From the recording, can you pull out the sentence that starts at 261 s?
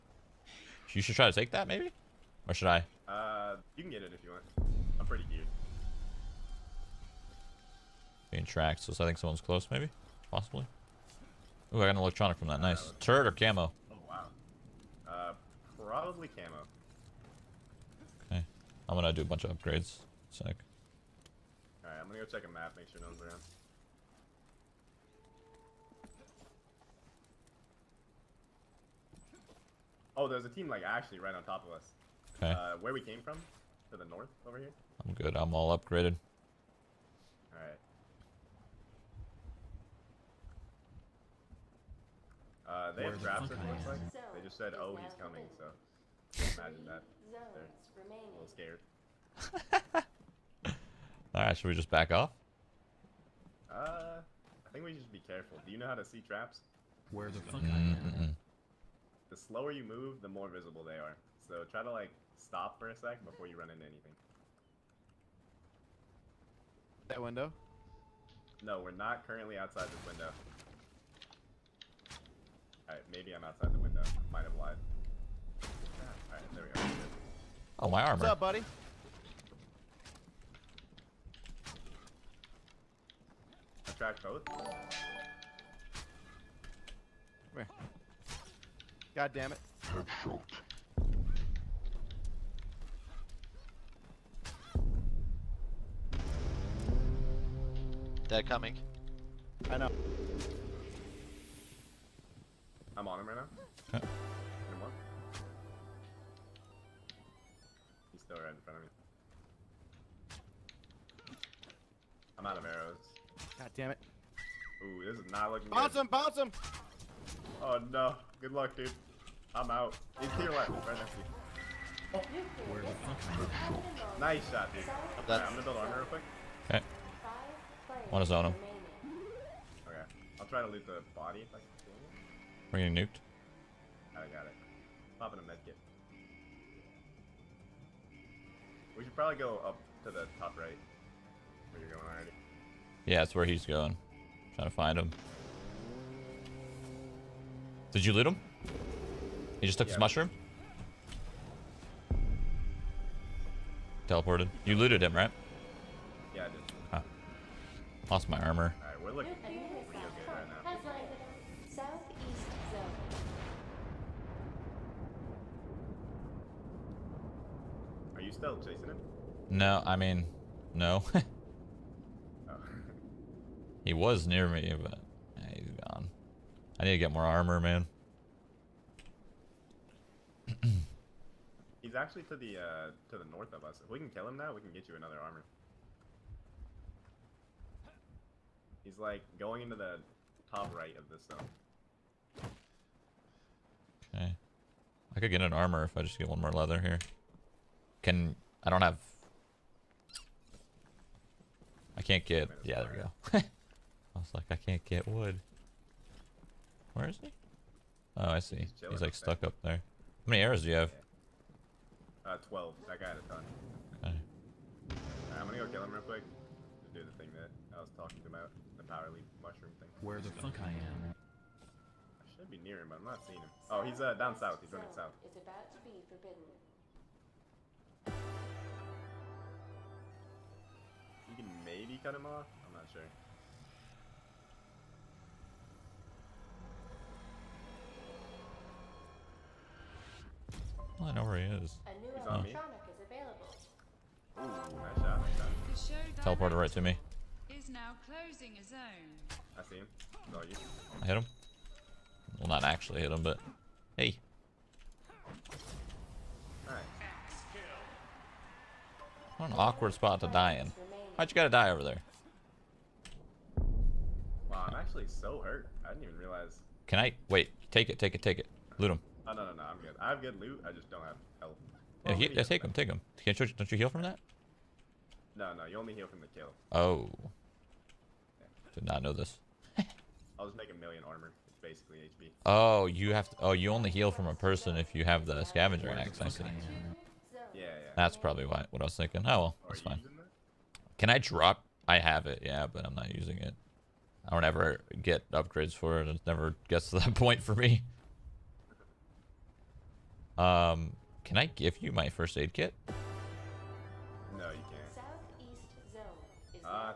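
Why'd you gotta die over there?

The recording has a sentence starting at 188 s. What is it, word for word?
He's like going into the top right of this zone.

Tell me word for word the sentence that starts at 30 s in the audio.
Oh, there's a team like actually right on top of us.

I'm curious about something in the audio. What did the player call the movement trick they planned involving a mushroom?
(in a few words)
Power leap.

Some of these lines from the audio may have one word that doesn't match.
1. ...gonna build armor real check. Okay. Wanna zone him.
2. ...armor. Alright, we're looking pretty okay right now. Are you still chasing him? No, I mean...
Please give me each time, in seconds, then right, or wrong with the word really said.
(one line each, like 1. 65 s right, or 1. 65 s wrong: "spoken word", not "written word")
1. 125 s wrong: "quick", not "check"
2. 158 s right.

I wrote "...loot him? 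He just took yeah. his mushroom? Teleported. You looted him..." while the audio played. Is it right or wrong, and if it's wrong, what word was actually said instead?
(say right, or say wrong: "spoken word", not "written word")
right.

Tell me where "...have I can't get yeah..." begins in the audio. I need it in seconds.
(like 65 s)
198 s.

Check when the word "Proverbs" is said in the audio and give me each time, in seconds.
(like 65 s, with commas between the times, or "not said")
not said.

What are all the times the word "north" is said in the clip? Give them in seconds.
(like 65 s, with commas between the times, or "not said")
34 s, 183 s.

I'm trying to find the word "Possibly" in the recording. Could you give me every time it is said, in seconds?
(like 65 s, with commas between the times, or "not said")
10 s.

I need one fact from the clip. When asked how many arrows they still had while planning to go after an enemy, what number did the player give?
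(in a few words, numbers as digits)
12.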